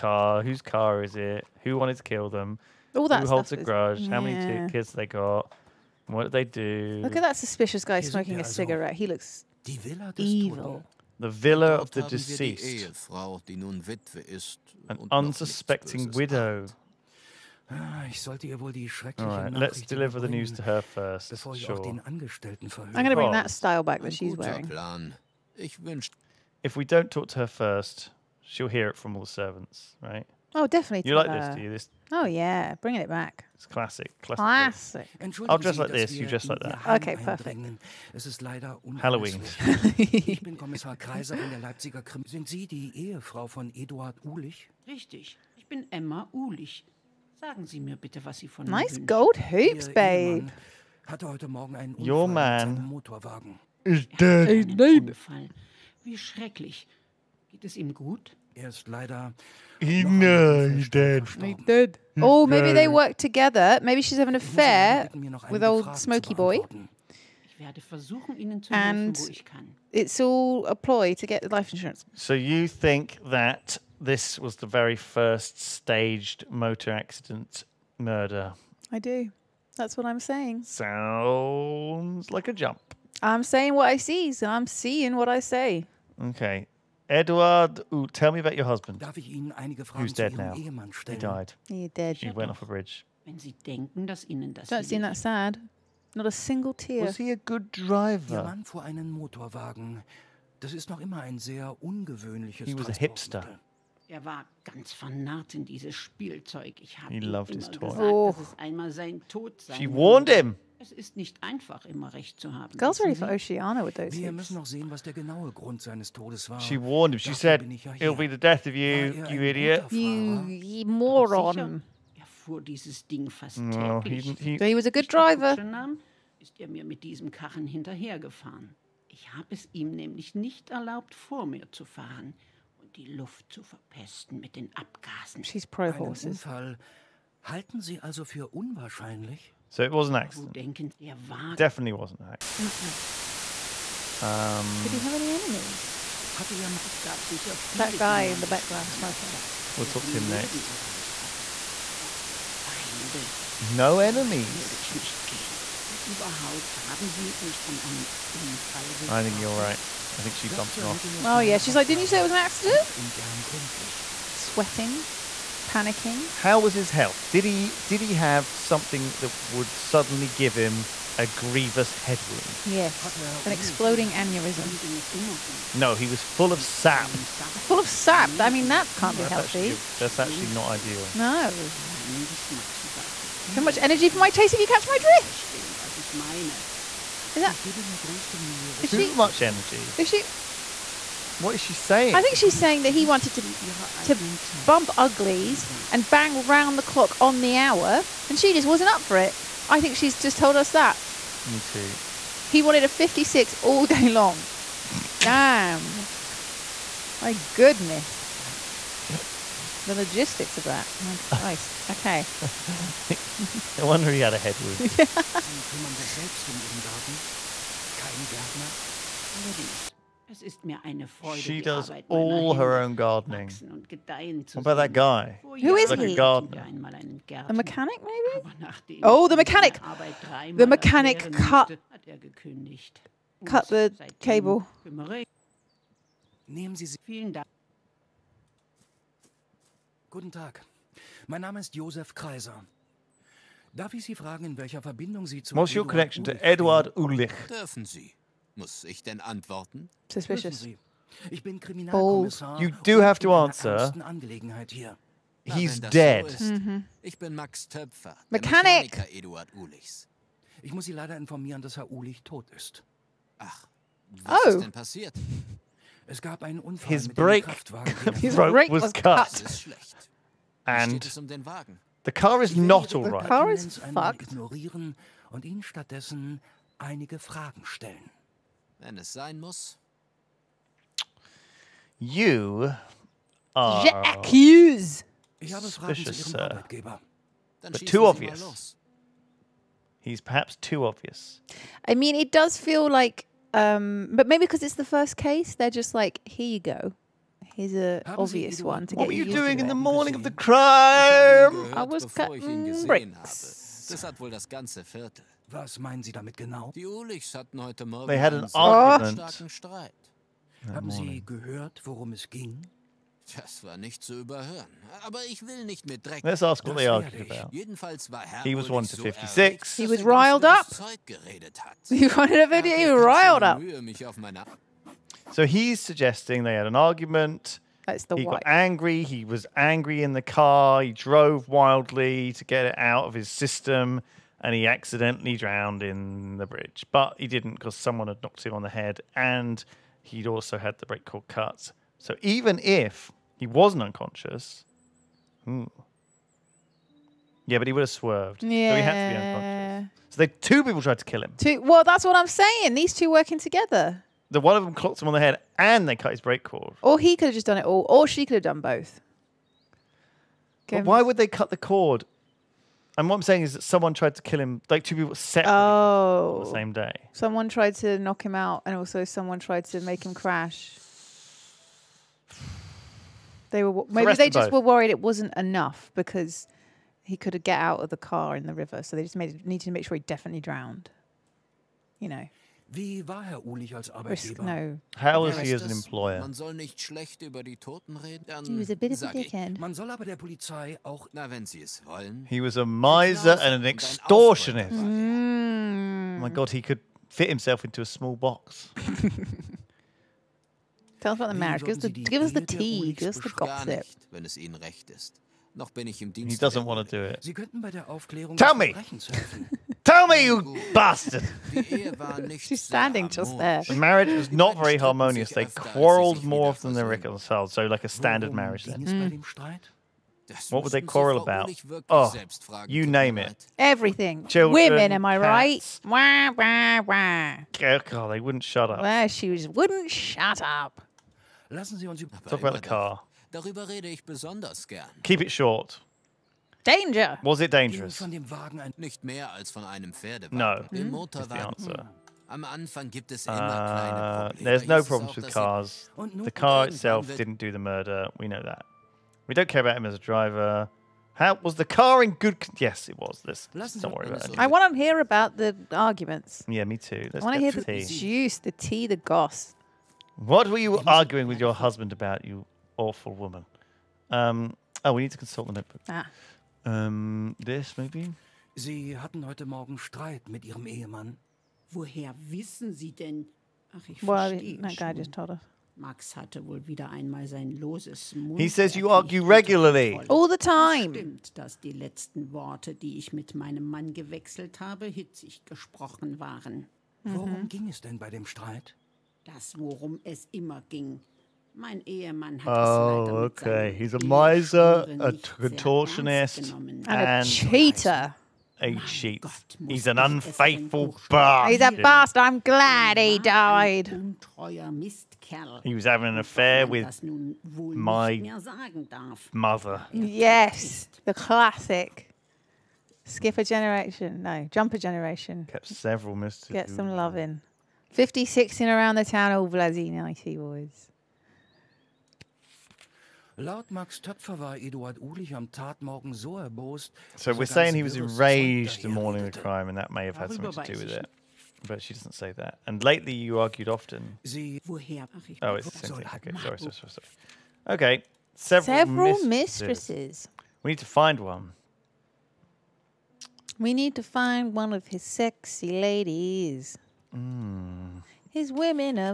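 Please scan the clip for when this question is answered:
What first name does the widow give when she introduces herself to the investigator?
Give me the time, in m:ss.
0:45.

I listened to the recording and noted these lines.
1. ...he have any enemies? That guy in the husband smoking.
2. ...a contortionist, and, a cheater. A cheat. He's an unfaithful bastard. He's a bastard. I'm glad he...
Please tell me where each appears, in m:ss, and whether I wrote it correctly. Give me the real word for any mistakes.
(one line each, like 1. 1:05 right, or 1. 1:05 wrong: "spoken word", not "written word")
1. 2:24 wrong: "background", not "husband"
2. 8:14 right.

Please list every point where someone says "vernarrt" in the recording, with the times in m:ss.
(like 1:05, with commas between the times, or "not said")
1:44.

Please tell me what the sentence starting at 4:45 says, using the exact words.
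Ich habe suspicious, zu Ihrem sir.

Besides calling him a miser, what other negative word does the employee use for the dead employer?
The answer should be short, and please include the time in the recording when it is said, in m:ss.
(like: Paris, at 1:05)
extortionist, at 6:33.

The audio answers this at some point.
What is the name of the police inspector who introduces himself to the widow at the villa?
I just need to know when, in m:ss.
0:40.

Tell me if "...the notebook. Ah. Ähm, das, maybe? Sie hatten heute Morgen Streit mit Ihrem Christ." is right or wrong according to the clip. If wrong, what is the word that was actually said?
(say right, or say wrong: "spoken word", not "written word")
wrong: "Ehemann", not "Christ".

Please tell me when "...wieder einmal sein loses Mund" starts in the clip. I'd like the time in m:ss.
7:56.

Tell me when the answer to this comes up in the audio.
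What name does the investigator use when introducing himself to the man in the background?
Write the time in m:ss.
4:01.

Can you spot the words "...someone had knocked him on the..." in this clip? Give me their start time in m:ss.
5:37.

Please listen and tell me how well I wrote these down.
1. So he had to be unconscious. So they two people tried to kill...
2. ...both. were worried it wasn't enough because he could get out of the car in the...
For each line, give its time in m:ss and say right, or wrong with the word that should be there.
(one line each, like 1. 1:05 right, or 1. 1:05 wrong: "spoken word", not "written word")
1. 5:48 right
2. 6:14 right.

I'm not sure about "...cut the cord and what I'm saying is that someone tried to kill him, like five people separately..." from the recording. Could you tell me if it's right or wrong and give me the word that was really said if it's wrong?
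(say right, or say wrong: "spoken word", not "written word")
wrong: "two", not "five".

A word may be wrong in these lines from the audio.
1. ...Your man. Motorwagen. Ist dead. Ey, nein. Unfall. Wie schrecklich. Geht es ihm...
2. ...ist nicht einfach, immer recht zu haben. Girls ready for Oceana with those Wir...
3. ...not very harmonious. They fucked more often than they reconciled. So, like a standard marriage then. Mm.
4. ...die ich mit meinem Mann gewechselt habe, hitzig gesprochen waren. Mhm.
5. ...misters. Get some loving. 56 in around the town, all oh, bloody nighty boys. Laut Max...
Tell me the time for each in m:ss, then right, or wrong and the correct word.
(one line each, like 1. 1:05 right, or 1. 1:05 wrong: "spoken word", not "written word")
1. 0:52 right
2. 1:50 right
3. 6:54 wrong: "quarrelled", not "fucked"
4. 8:02 right
5. 8:36 right.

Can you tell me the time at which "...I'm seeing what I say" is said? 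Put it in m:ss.
1:24.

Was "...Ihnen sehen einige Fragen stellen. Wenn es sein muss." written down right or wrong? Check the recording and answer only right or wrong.
wrong.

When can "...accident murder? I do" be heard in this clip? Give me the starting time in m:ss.
1:16.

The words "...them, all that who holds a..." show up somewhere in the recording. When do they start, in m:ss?
0:02.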